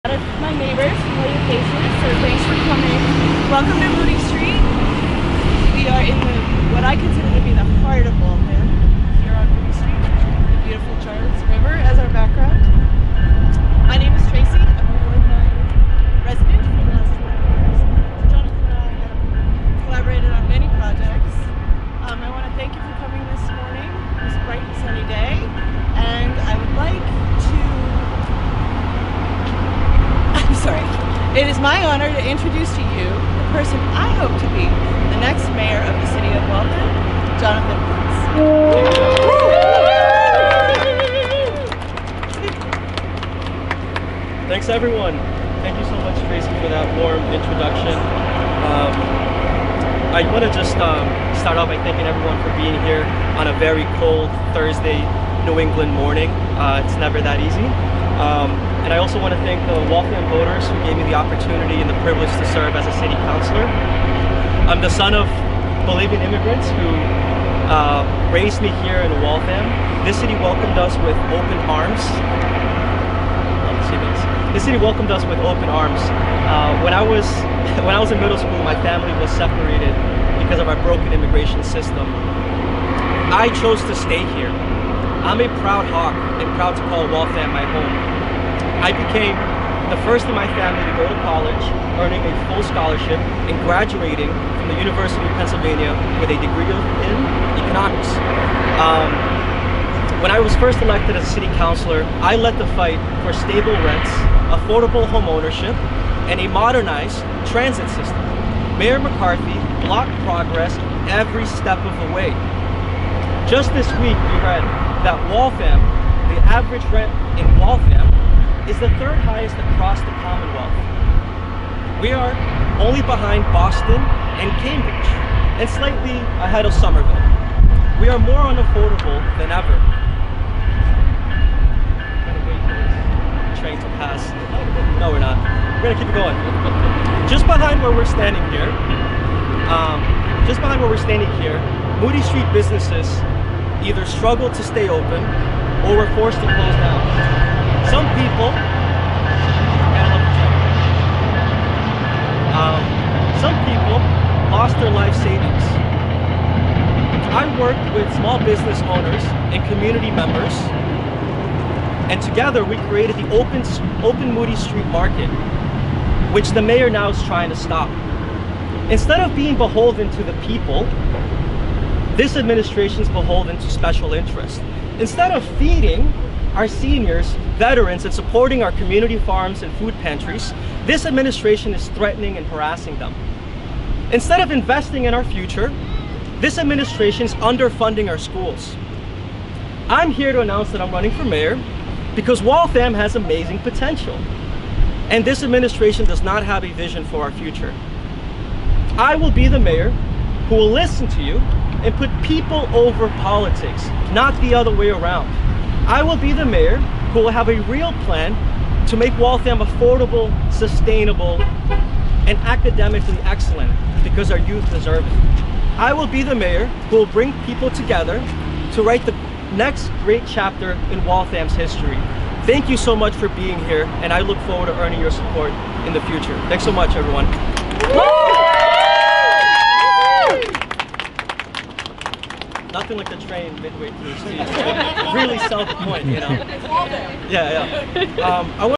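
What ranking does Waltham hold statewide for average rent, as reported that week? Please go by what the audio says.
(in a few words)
third highest.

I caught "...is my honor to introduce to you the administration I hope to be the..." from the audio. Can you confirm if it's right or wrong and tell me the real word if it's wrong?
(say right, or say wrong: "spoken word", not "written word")
wrong: "person", not "administration".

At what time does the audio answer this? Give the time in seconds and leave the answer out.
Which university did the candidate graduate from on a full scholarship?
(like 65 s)
94 s.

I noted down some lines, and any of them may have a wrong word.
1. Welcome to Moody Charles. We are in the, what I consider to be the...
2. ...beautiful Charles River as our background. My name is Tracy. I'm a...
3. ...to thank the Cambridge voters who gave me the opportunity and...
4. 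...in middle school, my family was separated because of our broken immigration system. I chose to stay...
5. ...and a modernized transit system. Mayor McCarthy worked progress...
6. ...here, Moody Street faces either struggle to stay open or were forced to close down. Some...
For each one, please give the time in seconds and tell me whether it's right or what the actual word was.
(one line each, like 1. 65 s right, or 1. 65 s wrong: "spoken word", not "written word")
1. 3 s wrong: "Street", not "Charles"
2. 10 s right
3. 59 s wrong: "Waltham", not "Cambridge"
4. 78 s right
5. 106 s wrong: "blocked", not "worked"
6. 141 s wrong: "businesses", not "faces".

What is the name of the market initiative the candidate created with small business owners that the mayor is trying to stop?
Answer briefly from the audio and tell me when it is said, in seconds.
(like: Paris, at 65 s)
Open Moody Street Market, at 163 s.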